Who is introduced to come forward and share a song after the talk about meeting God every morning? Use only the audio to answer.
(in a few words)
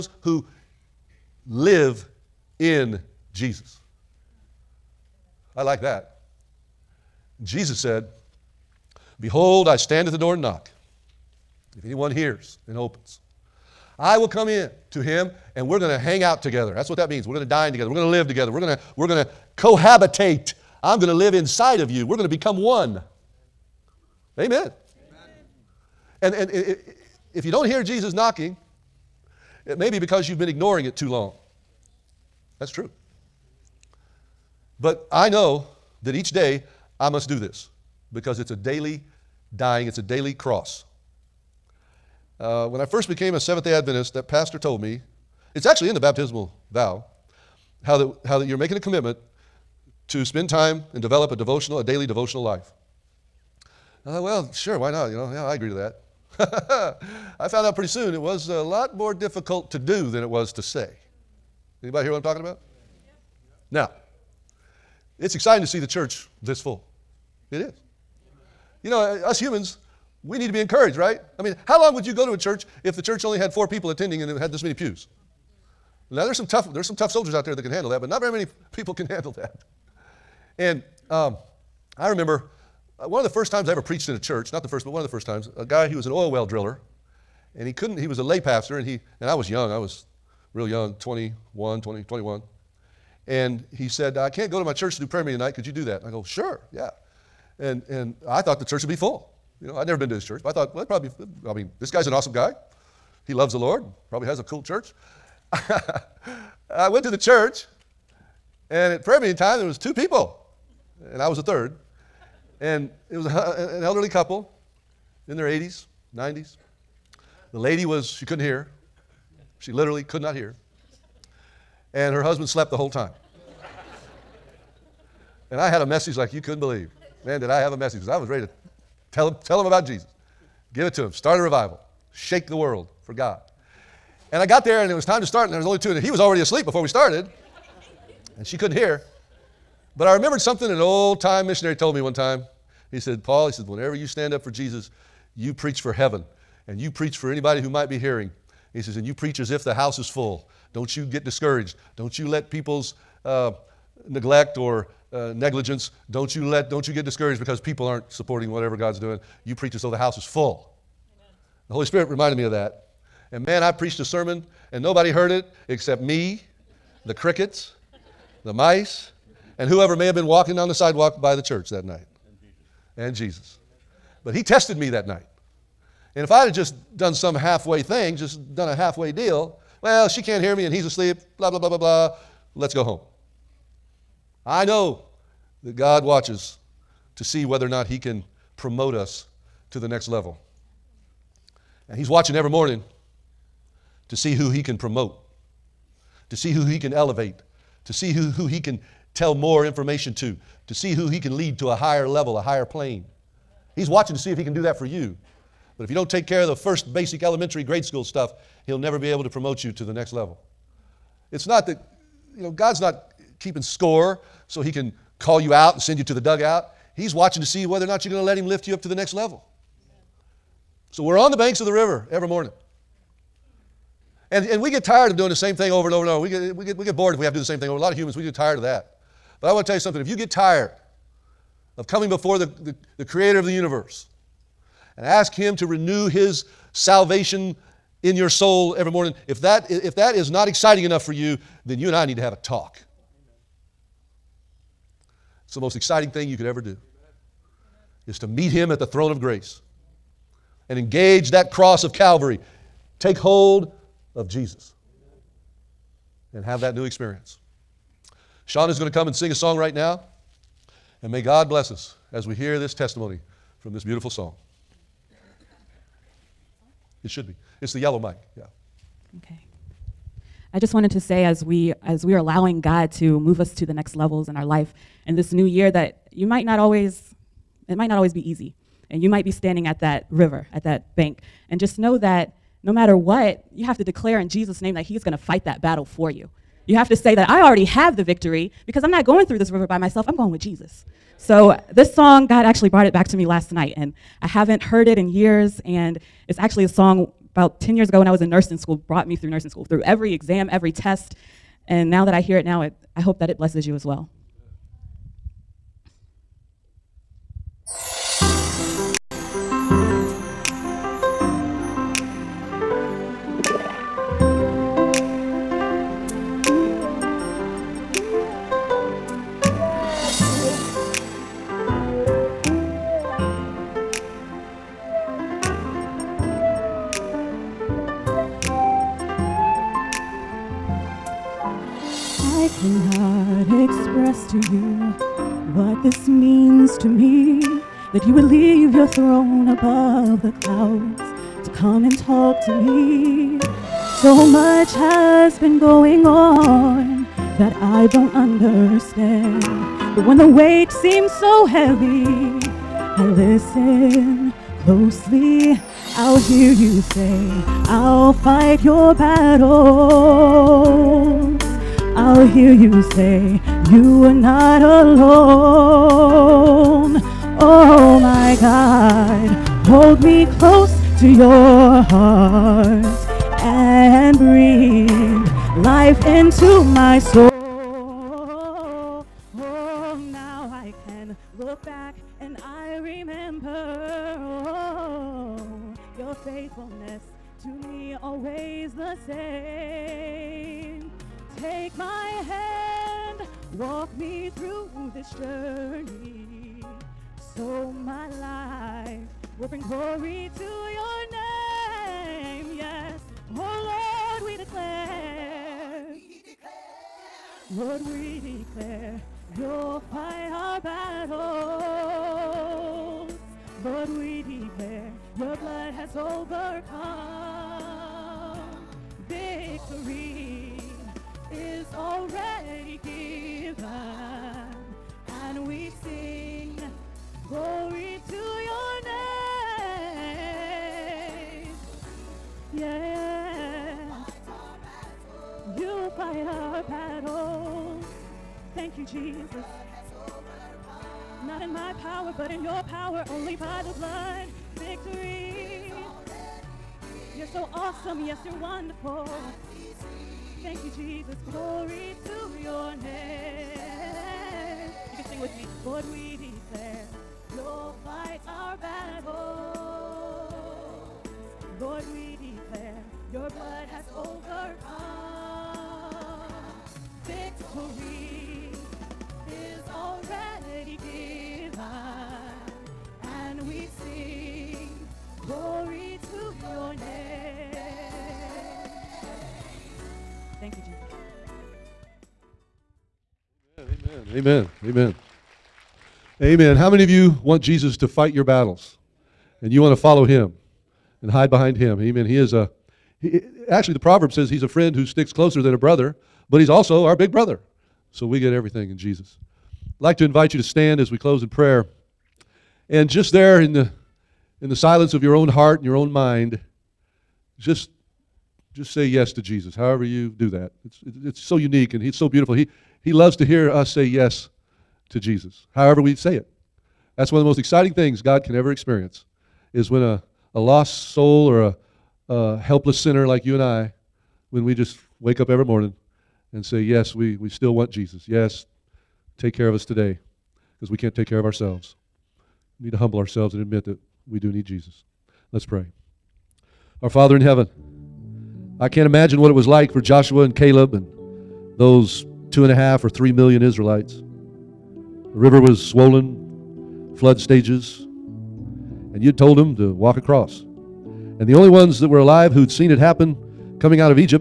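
Sean.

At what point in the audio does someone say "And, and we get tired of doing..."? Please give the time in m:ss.
3:44.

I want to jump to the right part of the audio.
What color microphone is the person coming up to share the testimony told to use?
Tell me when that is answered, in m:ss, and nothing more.
4:27.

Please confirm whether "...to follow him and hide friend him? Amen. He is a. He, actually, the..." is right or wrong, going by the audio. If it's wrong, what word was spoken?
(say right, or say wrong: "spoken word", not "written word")
wrong: "behind", not "friend".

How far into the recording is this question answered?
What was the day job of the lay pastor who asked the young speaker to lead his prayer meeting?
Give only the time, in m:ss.
1:26.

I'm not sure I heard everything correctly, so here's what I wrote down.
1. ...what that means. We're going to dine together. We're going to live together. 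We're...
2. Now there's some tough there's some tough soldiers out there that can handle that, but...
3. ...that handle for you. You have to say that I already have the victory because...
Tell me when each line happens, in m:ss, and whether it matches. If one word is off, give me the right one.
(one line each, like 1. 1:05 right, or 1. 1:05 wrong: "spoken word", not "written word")
1. 0:16 right
2. 1:16 right
3. 4:45 wrong: "battle", not "handle".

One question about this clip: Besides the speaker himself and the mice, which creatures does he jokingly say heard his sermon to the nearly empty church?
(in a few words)
Crickets.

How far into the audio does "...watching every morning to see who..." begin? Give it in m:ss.
3:12.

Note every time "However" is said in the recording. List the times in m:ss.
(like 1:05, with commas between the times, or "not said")
8:29, 8:35.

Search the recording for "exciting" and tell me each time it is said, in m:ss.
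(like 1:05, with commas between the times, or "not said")
1:05, 4:00, 4:05, 8:37.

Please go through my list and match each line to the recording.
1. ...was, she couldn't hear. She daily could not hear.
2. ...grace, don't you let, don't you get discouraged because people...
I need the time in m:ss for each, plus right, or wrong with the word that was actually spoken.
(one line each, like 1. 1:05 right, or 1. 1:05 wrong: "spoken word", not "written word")
1. 1:57 wrong: "literally", not "daily"
2. 2:35 wrong: "negligence", not "grace".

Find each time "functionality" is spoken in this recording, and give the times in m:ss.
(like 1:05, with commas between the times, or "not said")
not said.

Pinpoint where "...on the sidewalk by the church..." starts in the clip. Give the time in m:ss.
2:50.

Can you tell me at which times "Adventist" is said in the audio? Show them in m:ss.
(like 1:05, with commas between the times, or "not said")
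0:43.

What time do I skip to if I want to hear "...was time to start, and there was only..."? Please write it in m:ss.
2:14.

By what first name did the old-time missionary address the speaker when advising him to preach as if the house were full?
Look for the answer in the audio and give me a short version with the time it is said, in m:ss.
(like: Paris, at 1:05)
Paul, at 2:23.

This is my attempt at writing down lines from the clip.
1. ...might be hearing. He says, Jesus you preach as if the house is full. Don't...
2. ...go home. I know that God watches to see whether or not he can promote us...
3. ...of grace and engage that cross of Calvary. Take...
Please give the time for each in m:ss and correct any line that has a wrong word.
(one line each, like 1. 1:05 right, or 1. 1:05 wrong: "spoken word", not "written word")
1. 2:27 wrong: "And", not "Jesus"
2. 3:02 right
3. 4:09 right.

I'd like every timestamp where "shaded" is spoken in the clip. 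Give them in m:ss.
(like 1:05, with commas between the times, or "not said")
not said.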